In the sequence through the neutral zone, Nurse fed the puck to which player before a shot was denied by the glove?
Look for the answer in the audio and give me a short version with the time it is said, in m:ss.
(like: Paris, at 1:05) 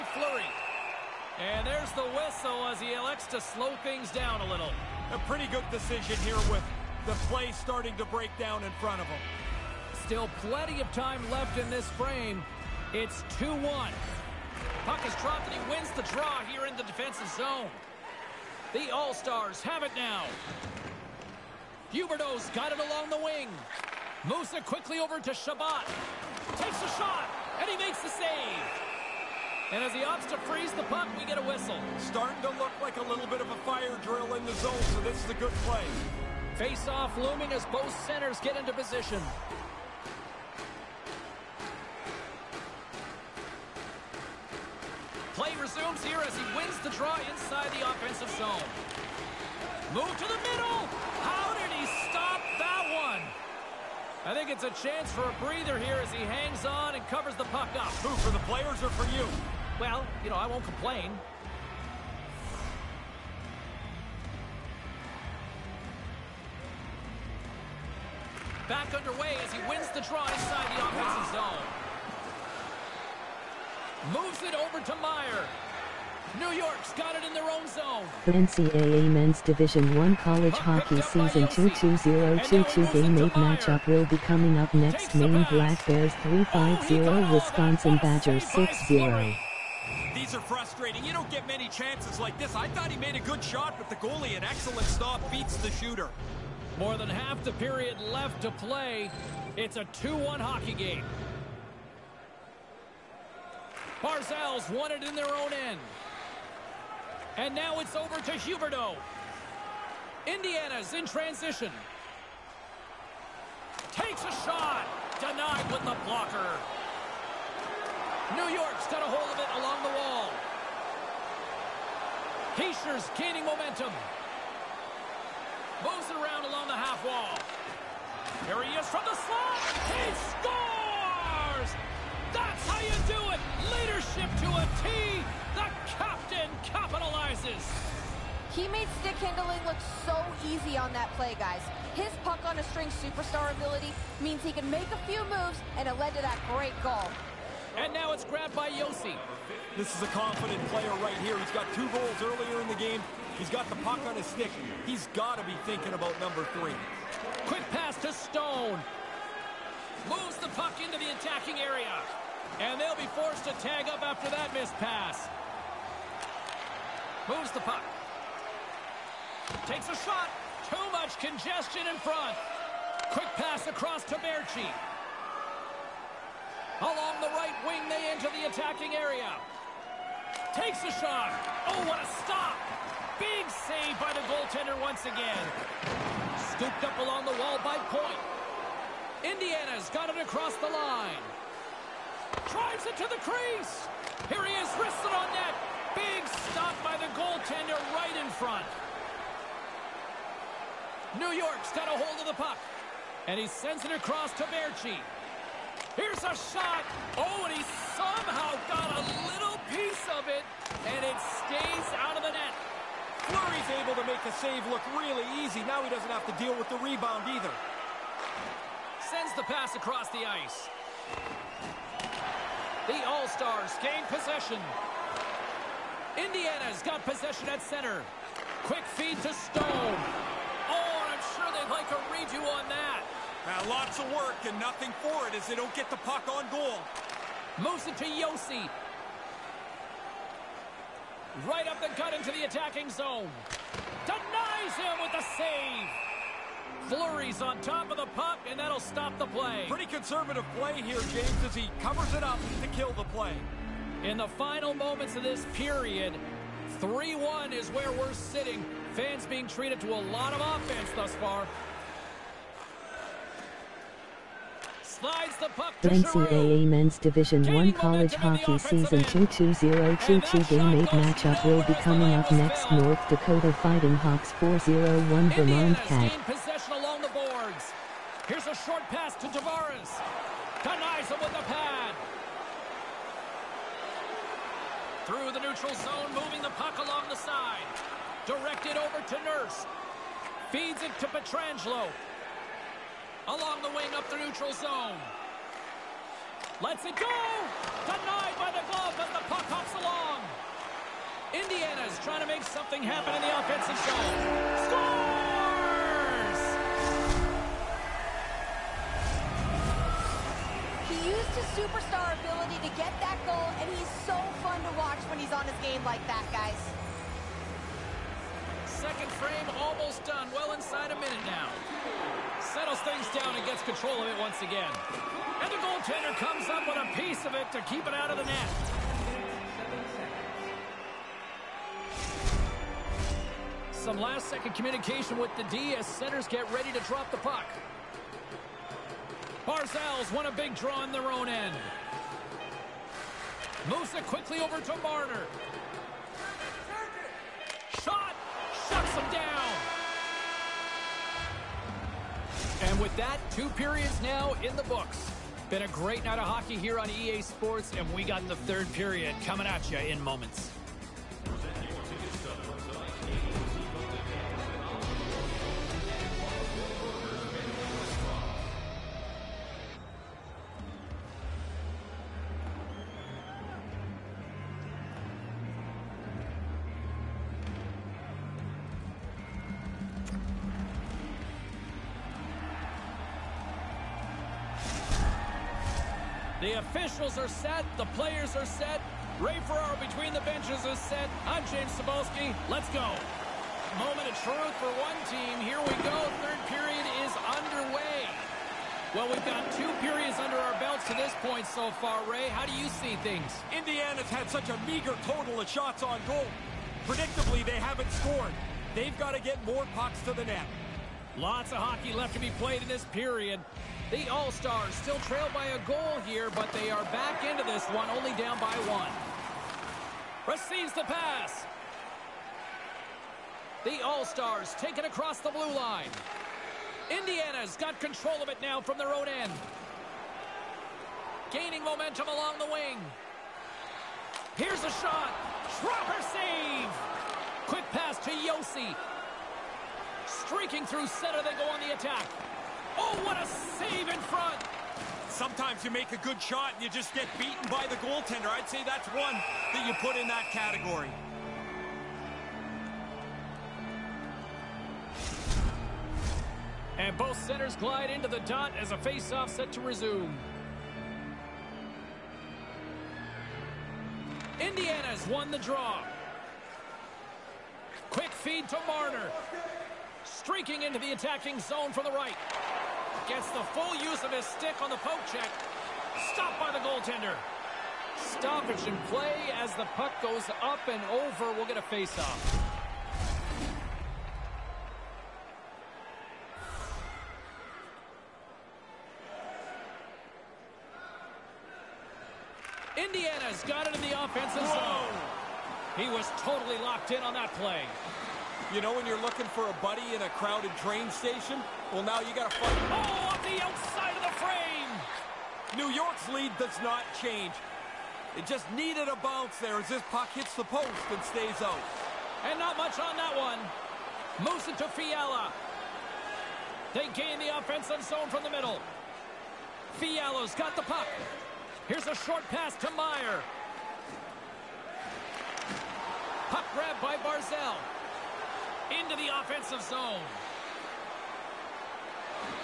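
Pietrangelo, at 4:51.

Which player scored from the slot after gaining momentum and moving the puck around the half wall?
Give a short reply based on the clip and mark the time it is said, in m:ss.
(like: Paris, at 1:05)
Hischier, at 2:02.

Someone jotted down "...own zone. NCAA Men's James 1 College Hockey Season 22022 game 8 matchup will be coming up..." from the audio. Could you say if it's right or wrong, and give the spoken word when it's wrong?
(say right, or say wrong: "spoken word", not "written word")
wrong: "Division", not "James".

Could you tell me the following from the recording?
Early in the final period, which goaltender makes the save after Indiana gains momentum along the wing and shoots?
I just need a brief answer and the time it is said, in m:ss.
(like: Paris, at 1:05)
Schropper, at 7:15.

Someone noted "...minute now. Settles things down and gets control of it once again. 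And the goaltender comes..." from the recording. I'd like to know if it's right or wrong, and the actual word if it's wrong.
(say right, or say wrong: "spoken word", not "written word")
right.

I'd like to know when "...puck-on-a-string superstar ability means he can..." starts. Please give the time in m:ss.
2:22.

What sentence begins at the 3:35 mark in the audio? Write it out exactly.
Now he doesn't have to deal with the rebound either.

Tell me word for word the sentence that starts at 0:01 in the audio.
And there's the whistle as he elects to slow things down a little.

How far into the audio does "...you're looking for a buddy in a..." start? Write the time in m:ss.
8:18.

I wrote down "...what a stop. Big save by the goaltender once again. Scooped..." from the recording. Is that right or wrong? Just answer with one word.
right.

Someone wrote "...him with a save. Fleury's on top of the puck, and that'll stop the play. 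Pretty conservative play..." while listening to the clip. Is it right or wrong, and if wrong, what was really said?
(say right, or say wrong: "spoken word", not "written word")
right.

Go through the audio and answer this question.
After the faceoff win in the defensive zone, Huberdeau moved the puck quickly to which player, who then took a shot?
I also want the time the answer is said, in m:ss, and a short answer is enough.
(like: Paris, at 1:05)
Shabat, at 0:25.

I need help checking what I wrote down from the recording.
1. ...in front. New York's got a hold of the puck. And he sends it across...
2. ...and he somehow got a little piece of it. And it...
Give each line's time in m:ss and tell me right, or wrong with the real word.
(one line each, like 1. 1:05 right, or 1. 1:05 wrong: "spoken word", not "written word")
1. 3:18 right
2. 3:27 right.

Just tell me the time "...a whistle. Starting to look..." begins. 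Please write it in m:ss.
0:31.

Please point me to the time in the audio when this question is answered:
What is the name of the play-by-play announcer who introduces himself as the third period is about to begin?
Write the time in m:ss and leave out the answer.
6:31.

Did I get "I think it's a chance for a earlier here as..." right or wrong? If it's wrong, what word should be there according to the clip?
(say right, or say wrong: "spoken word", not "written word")
wrong: "breather", not "earlier".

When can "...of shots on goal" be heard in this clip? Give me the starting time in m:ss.
6:45.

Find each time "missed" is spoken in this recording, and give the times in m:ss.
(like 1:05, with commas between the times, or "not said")
2:44.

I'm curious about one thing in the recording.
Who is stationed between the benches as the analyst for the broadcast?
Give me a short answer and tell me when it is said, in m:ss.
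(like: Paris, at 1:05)
Ray Ferraro, at 6:29.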